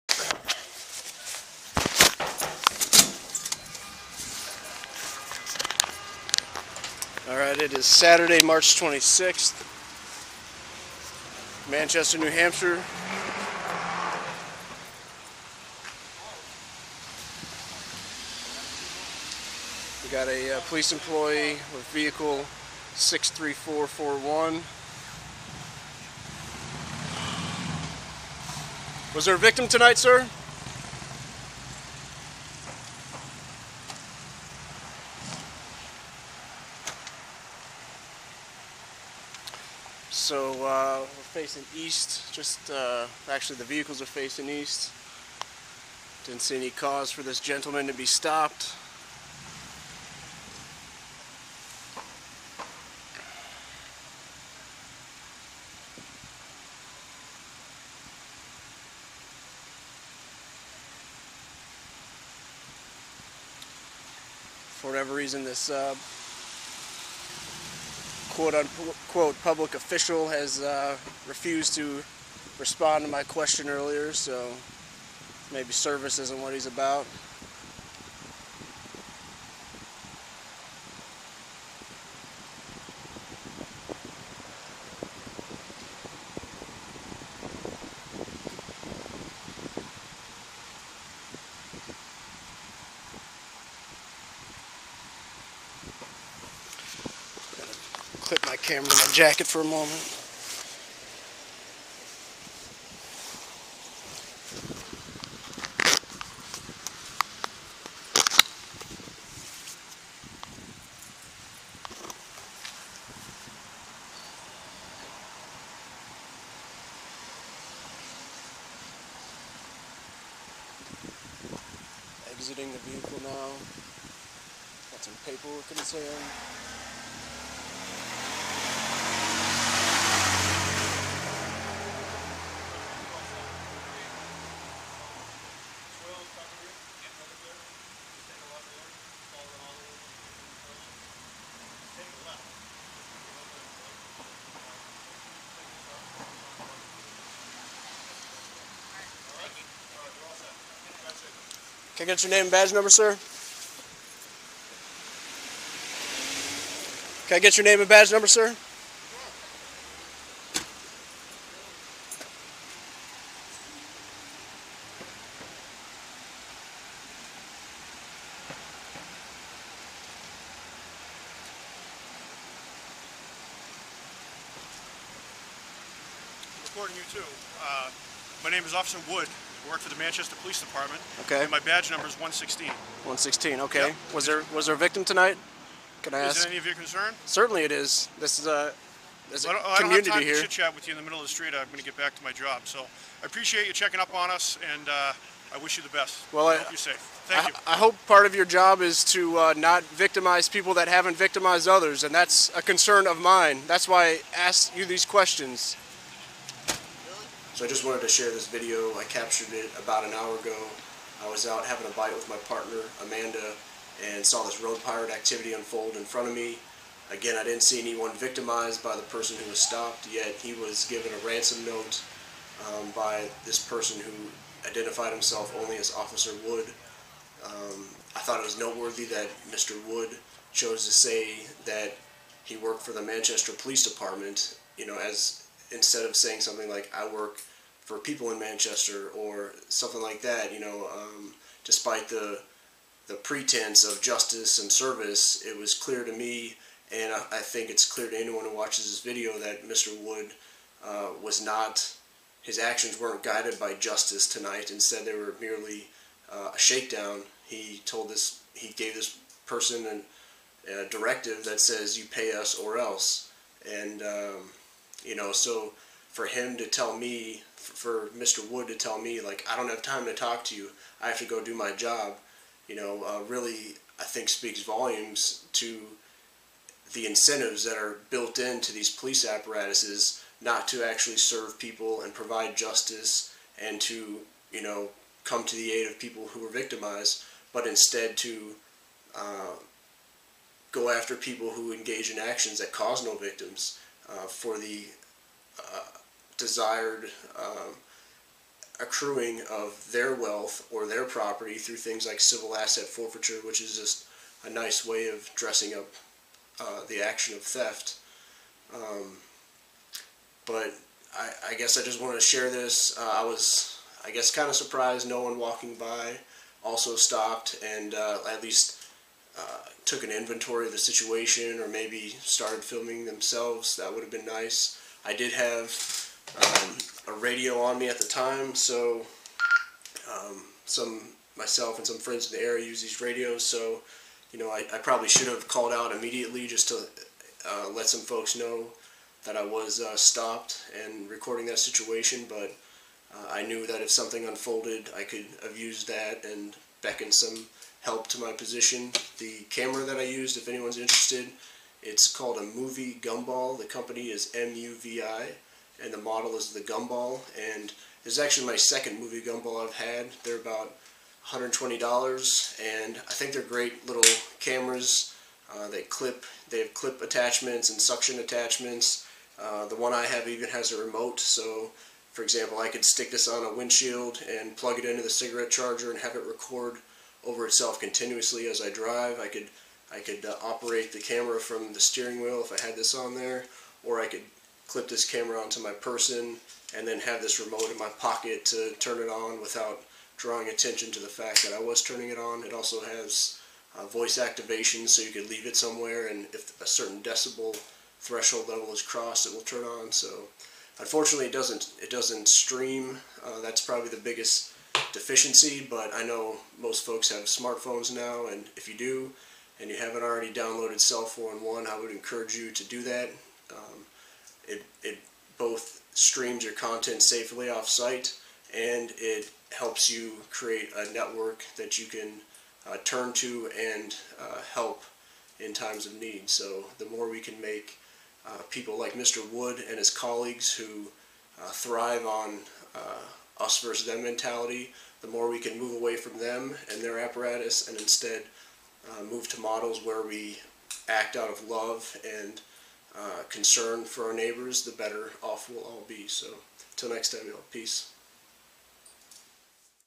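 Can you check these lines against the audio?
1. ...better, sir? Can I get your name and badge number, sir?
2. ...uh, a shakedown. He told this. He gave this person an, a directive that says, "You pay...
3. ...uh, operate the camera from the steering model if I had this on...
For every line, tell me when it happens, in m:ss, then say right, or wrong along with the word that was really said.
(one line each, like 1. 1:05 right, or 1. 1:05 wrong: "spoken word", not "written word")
1. 2:32 wrong: "number", not "better"
2. 4:16 right
3. 6:20 wrong: "wheel", not "model".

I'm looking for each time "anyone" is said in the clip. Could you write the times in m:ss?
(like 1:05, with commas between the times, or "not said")
3:37, 4:08, 5:50.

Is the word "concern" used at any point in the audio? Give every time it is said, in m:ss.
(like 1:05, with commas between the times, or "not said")
3:06, 3:22, 7:23.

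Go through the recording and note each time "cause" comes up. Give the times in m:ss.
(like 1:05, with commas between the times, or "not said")
0:46, 4:52.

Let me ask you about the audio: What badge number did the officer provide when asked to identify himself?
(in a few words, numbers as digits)
116.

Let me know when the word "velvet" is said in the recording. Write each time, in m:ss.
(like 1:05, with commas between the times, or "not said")
not said.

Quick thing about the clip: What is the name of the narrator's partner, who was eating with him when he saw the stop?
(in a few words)
Amanda.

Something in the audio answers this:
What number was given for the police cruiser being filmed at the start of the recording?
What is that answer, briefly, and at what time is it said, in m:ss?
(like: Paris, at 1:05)
63441, at 0:22.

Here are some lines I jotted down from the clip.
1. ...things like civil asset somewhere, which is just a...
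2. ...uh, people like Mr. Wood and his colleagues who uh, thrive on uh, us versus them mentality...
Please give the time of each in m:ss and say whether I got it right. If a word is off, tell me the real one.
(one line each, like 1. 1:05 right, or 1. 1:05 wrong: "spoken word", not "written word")
1. 5:01 wrong: "forfeiture", not "somewhere"
2. 7:08 right.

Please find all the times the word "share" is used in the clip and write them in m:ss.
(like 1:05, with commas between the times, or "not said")
3:28, 5:12.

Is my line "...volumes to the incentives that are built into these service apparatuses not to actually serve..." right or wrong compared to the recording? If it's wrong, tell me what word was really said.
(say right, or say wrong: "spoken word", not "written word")
wrong: "police", not "service".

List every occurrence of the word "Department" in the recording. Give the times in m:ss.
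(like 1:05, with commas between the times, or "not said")
3:00, 3:53.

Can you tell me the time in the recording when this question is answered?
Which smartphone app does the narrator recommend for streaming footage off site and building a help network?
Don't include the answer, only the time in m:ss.
6:50.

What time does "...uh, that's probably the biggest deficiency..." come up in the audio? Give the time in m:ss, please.
6:43.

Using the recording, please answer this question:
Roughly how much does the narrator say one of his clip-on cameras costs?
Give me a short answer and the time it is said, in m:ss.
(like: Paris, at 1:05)
$120, at 6:01.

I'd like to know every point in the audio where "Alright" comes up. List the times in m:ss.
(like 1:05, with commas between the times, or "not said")
0:07.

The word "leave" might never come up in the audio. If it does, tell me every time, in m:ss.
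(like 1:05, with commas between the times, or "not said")
6:35.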